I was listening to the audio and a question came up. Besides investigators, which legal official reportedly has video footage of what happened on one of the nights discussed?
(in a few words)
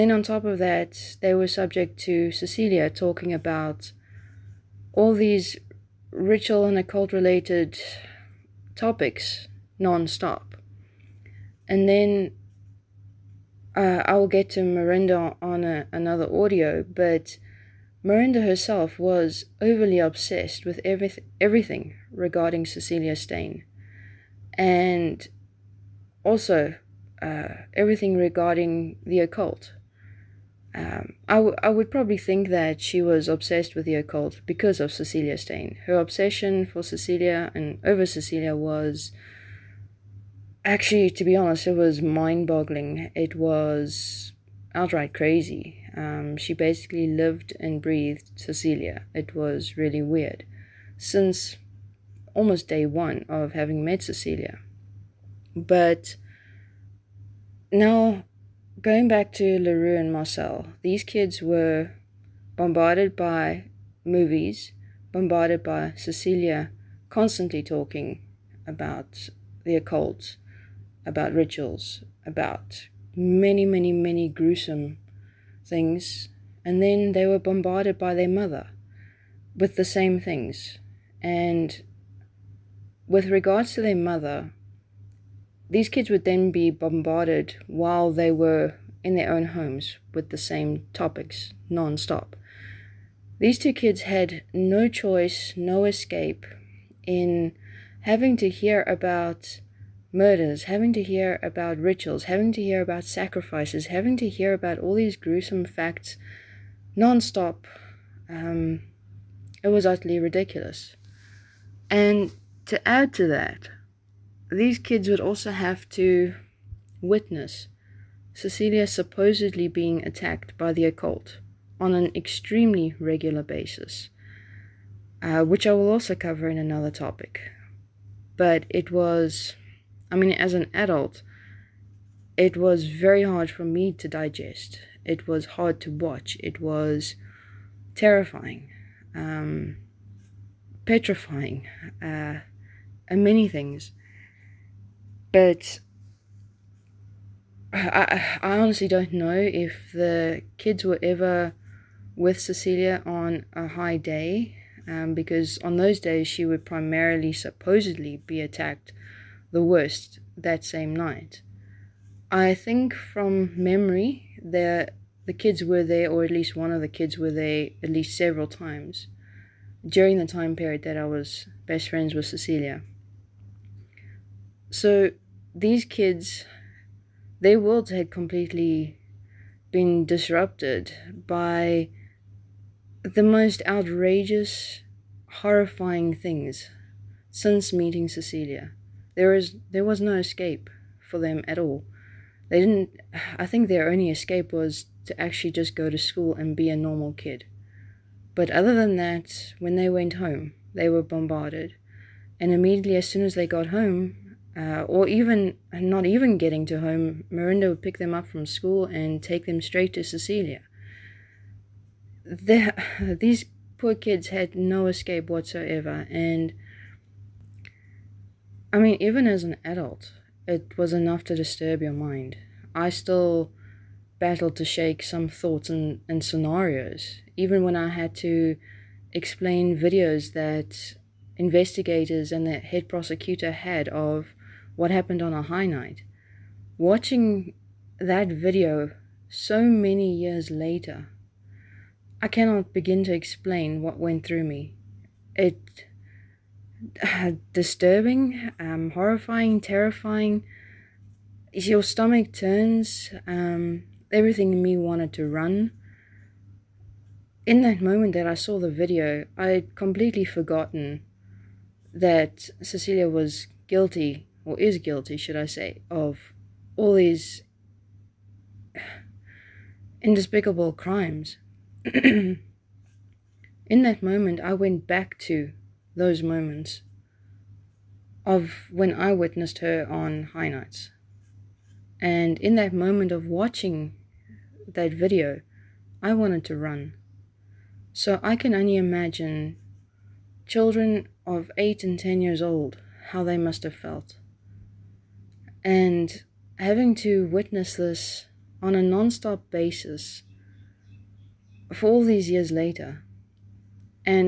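head prosecutor.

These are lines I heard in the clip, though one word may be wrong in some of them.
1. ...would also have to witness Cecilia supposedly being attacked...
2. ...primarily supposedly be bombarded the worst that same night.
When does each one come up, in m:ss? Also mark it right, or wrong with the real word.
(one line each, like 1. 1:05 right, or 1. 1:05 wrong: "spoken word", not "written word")
1. 1:55 right
2. 2:36 wrong: "attacked", not "bombarded".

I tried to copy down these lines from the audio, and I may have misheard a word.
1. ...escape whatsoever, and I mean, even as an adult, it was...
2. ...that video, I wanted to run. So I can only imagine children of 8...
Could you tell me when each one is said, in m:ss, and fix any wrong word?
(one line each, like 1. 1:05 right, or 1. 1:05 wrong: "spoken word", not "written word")
1. 3:34 right
2. 4:44 right.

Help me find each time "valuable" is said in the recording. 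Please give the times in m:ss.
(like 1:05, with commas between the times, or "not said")
not said.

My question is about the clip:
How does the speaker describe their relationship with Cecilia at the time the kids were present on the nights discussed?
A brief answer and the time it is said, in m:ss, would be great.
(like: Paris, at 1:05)
best friends, at 2:51.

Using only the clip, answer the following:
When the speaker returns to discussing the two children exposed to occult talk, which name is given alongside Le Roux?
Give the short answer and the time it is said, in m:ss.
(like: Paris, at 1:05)
Marcel, at 1:00.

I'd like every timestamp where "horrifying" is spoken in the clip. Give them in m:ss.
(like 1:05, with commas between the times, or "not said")
3:05, 4:08.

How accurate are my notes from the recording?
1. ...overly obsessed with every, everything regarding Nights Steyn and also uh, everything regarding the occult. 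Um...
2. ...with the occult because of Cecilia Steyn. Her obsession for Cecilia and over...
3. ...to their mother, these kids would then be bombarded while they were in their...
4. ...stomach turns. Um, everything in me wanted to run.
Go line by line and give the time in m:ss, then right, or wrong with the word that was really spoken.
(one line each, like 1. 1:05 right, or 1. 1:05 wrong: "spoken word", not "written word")
1. 0:19 wrong: "Cecilia", not "Nights"
2. 0:33 right
3. 1:23 right
4. 4:11 right.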